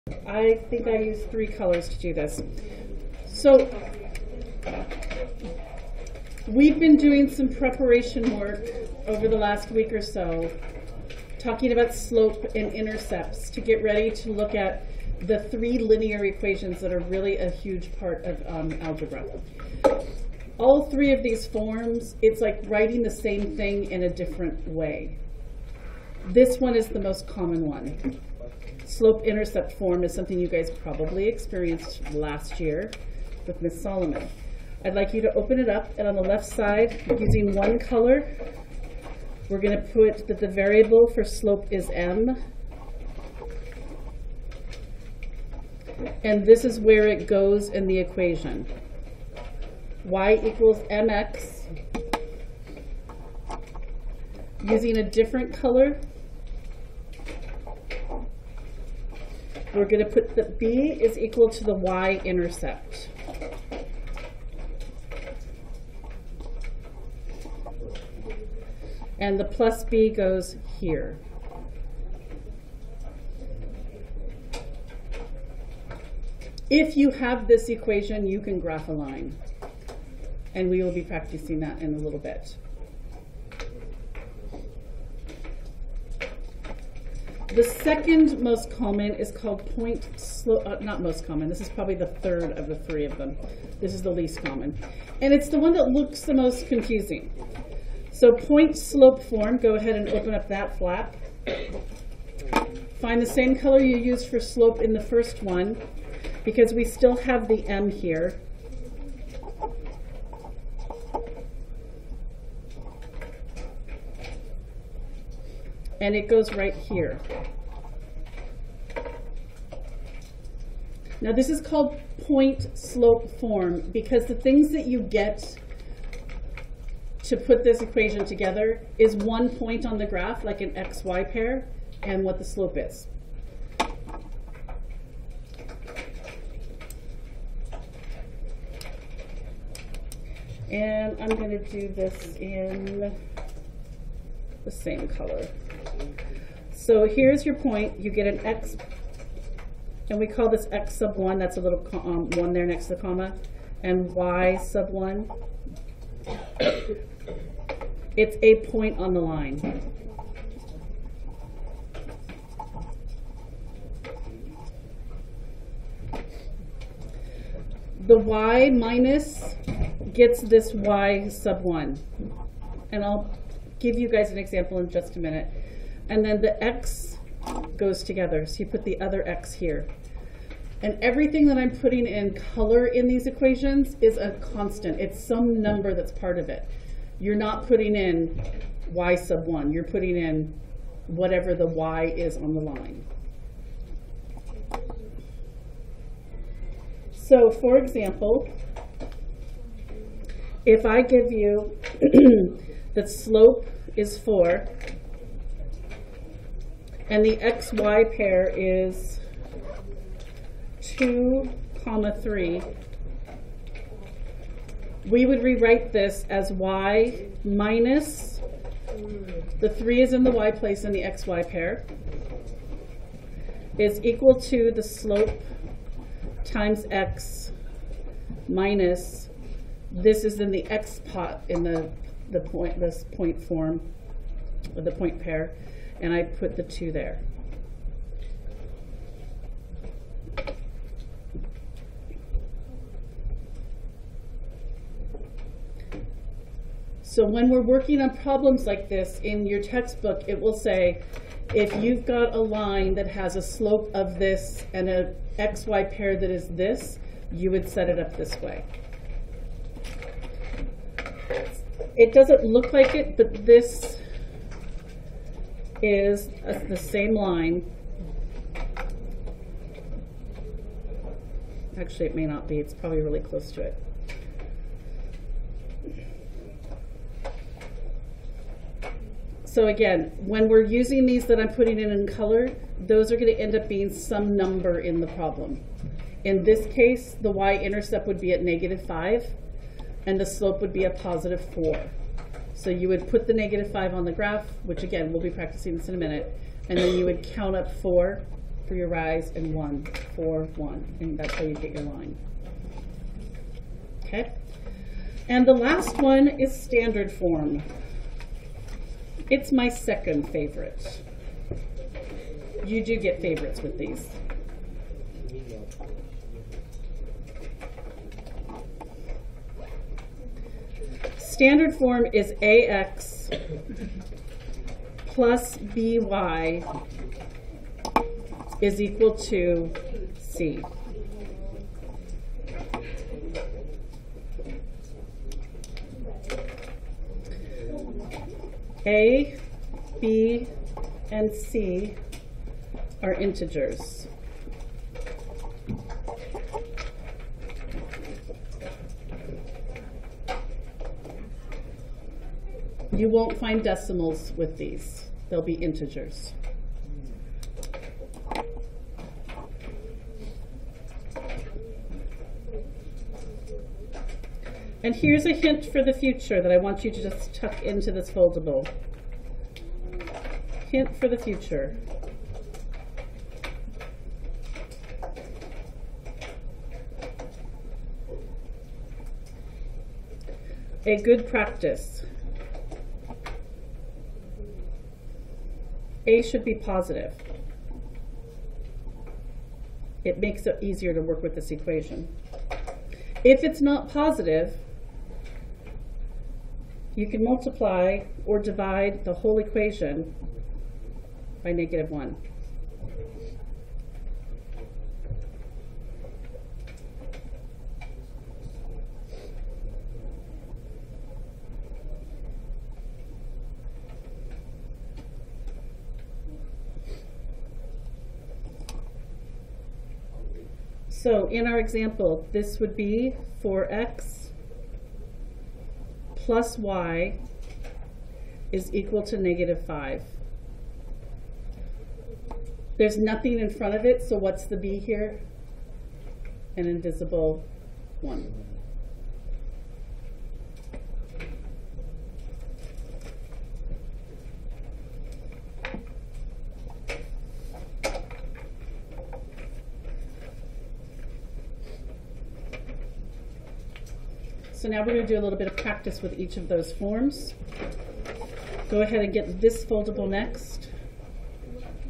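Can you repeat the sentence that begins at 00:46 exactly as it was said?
And this is where it goes in the equation.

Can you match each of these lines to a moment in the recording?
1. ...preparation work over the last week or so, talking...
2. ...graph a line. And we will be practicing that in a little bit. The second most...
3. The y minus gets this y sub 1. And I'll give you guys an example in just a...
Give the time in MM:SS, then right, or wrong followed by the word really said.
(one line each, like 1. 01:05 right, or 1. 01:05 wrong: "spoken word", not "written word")
1. 00:07 right
2. 01:18 right
3. 02:48 right.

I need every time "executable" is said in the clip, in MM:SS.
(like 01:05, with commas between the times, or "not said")
not said.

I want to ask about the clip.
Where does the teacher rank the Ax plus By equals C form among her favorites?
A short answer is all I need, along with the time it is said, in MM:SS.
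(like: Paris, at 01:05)
second favorite, at 05:09.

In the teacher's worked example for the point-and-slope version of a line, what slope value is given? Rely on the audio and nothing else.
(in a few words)
4.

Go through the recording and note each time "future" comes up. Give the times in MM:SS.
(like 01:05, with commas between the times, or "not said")
06:05, 06:11.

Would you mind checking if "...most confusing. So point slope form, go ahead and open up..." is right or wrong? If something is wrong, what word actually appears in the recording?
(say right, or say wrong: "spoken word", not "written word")
right.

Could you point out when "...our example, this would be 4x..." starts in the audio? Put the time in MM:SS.
07:01.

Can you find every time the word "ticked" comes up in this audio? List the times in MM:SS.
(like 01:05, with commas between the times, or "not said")
not said.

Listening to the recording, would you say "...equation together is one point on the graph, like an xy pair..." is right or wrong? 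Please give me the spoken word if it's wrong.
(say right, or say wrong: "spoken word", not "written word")
right.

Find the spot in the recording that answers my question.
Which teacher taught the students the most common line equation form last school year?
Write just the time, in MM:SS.
00:33.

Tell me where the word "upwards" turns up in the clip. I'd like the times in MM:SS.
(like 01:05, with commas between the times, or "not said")
not said.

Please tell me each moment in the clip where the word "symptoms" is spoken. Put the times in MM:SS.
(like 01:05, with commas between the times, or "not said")
not said.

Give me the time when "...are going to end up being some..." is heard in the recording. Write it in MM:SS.
04:43.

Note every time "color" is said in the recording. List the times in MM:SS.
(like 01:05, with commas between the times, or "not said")
00:01, 00:37, 00:55, 01:43, 02:25, 03:02, 04:42.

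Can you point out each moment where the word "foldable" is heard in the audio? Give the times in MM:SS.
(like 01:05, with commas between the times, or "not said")
06:08, 07:39.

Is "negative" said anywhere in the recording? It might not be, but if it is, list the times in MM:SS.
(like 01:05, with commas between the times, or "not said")
04:48, 04:53, 06:41, 07:09.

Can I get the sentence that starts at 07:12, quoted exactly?
There's nothing in front of it, so what's the b here?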